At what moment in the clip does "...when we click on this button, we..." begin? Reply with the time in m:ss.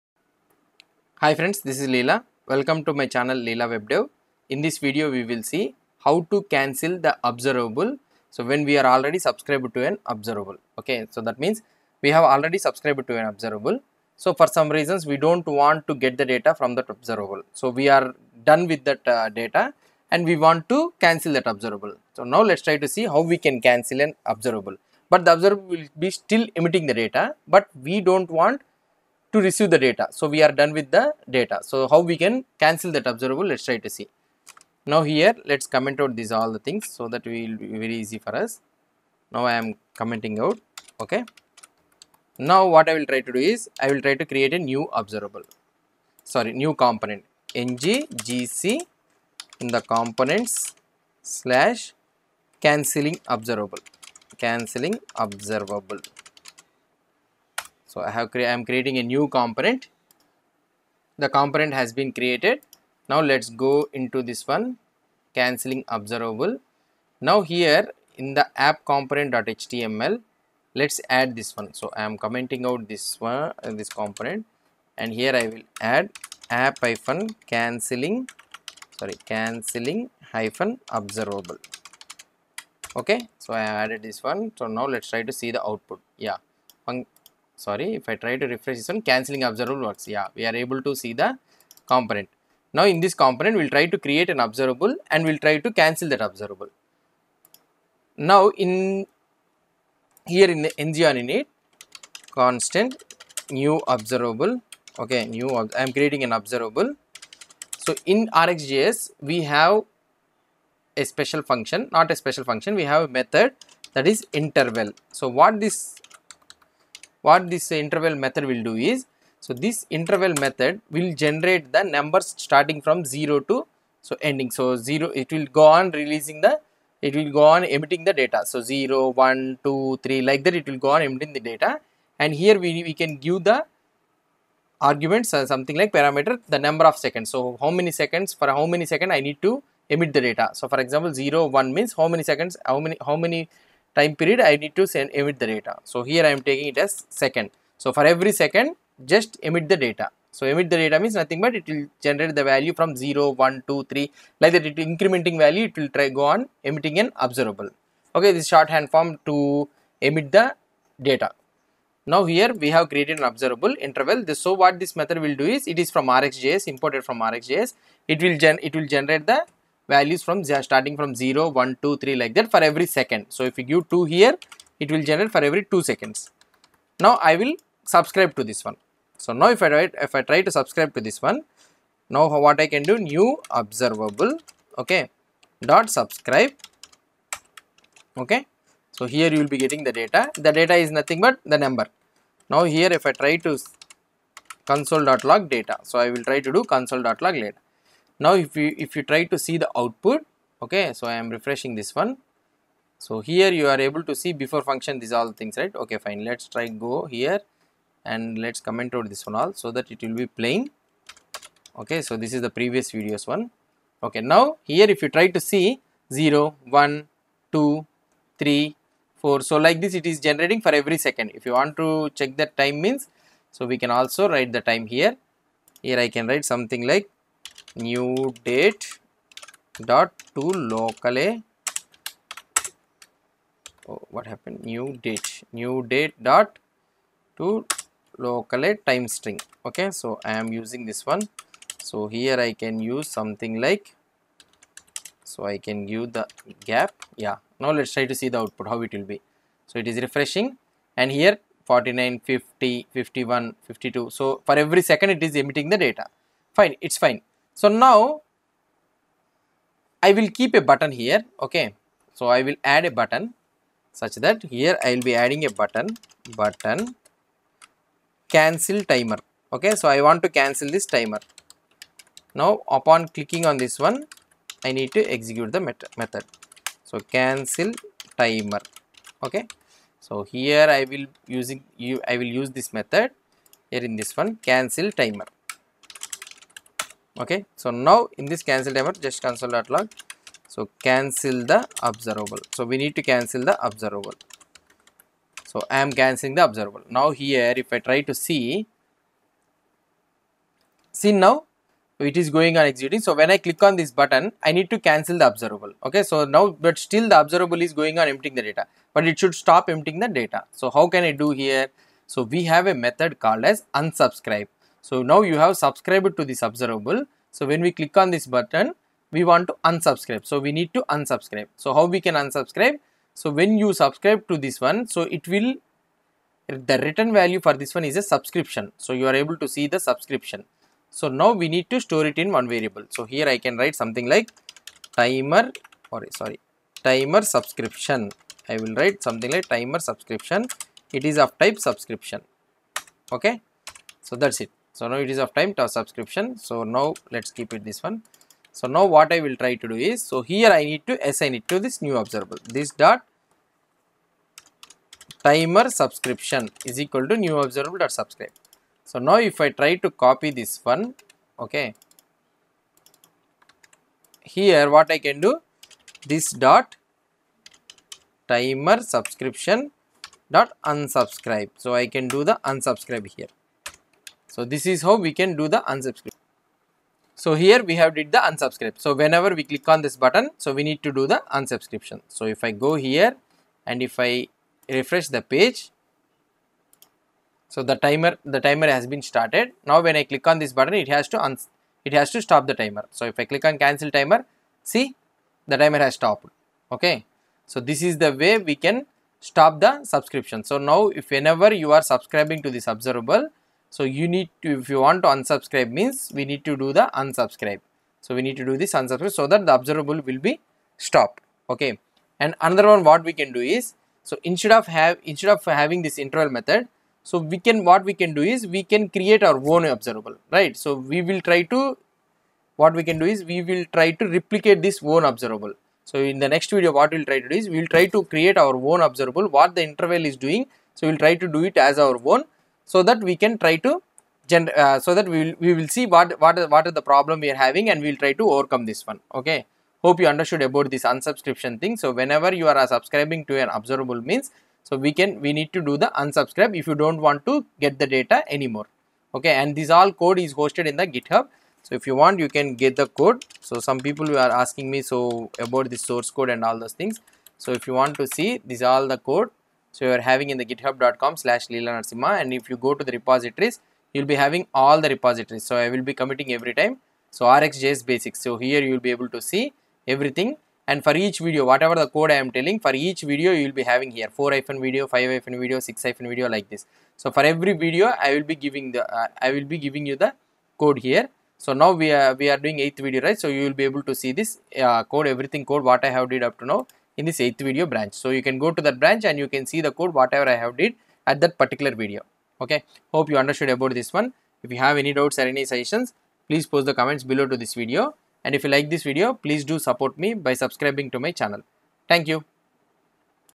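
5:17.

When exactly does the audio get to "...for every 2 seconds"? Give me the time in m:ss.
2:55.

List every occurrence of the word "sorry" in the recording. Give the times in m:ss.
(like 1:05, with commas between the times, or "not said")
0:46, 1:18, 1:27, 5:36.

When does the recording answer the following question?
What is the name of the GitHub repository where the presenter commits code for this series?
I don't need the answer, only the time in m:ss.
7:47.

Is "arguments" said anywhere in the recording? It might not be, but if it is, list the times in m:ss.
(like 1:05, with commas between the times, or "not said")
2:14.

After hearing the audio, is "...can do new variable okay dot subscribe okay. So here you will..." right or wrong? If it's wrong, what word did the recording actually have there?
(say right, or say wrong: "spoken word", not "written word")
wrong: "observable", not "variable".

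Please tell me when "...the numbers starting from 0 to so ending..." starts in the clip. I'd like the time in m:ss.
2:01.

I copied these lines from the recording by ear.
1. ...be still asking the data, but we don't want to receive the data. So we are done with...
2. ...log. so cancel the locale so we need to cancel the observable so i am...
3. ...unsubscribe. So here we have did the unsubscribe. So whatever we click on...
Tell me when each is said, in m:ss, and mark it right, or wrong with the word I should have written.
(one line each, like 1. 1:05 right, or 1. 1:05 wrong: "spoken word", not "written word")
1. 0:25 wrong: "emitting", not "asking"
2. 4:49 wrong: "observable", not "locale"
3. 6:15 wrong: "whenever", not "whatever".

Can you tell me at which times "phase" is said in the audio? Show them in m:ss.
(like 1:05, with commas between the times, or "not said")
not said.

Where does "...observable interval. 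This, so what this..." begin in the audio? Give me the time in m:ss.
2:43.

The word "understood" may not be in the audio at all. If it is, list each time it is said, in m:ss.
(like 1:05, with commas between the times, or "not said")
7:20, 8:13.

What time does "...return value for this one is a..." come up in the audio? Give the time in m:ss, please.
5:26.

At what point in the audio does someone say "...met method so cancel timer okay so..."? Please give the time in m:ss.
4:35.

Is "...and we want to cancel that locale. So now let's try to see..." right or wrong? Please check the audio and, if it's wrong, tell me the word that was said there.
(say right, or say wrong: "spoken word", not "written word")
wrong: "observable", not "locale".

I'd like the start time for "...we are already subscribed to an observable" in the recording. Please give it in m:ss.
0:08.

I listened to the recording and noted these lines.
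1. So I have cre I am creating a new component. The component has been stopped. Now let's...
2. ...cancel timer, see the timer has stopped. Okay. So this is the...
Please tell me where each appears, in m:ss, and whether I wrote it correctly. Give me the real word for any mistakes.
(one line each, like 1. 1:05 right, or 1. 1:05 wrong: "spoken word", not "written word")
1. 0:57 wrong: "created", not "stopped"
2. 6:33 right.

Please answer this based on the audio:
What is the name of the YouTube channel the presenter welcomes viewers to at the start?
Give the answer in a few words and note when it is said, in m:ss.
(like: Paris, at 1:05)
Leela WebDev, at 0:03.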